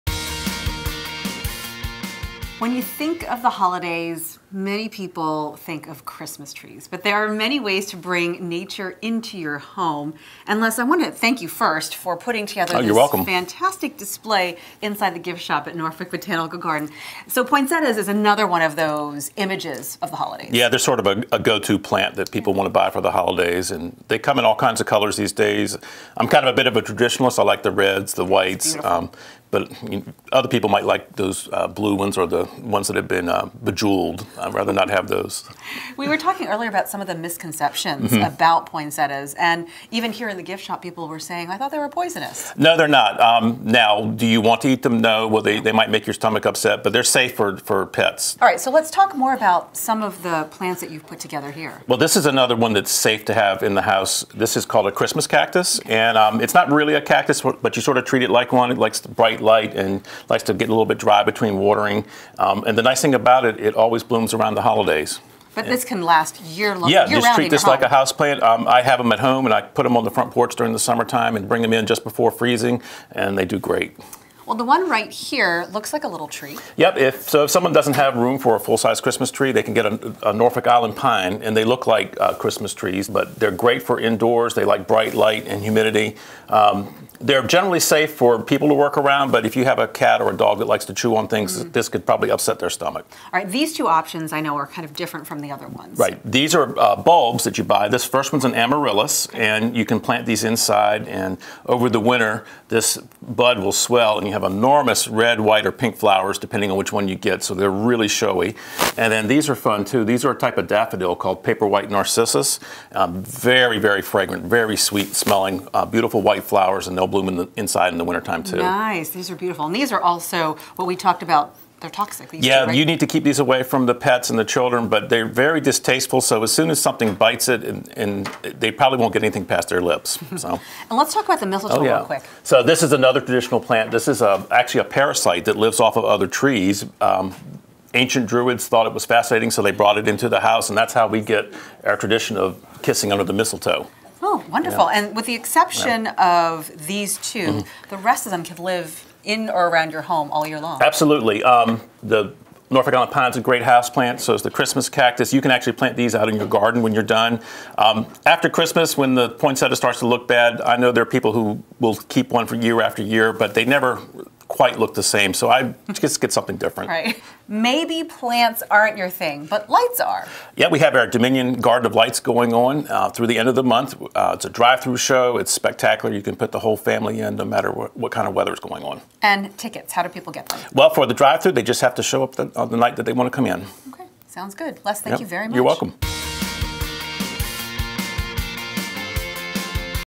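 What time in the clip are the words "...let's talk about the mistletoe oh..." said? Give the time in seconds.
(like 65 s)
130 s.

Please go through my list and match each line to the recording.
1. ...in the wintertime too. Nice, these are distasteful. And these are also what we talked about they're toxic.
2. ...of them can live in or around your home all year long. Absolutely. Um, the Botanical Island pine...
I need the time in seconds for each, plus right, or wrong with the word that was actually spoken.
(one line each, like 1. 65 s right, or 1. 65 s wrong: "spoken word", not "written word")
1. 117 s wrong: "beautiful", not "distasteful"
2. 148 s wrong: "Norfolk", not "Botanical".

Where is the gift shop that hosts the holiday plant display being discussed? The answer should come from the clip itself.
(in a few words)
Norfolk Botanical Garden.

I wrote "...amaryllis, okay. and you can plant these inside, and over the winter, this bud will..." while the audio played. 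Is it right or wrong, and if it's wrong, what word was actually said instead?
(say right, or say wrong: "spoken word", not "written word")
right.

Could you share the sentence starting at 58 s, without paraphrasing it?
It likes bright quite light and likes to get a little bit dry between watering.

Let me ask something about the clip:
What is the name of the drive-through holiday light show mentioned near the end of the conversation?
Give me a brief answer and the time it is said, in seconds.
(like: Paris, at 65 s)
Dominion Garden of Lights, at 171 s.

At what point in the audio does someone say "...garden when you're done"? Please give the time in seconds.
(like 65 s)
156 s.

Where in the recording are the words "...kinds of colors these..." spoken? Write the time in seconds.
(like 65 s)
24 s.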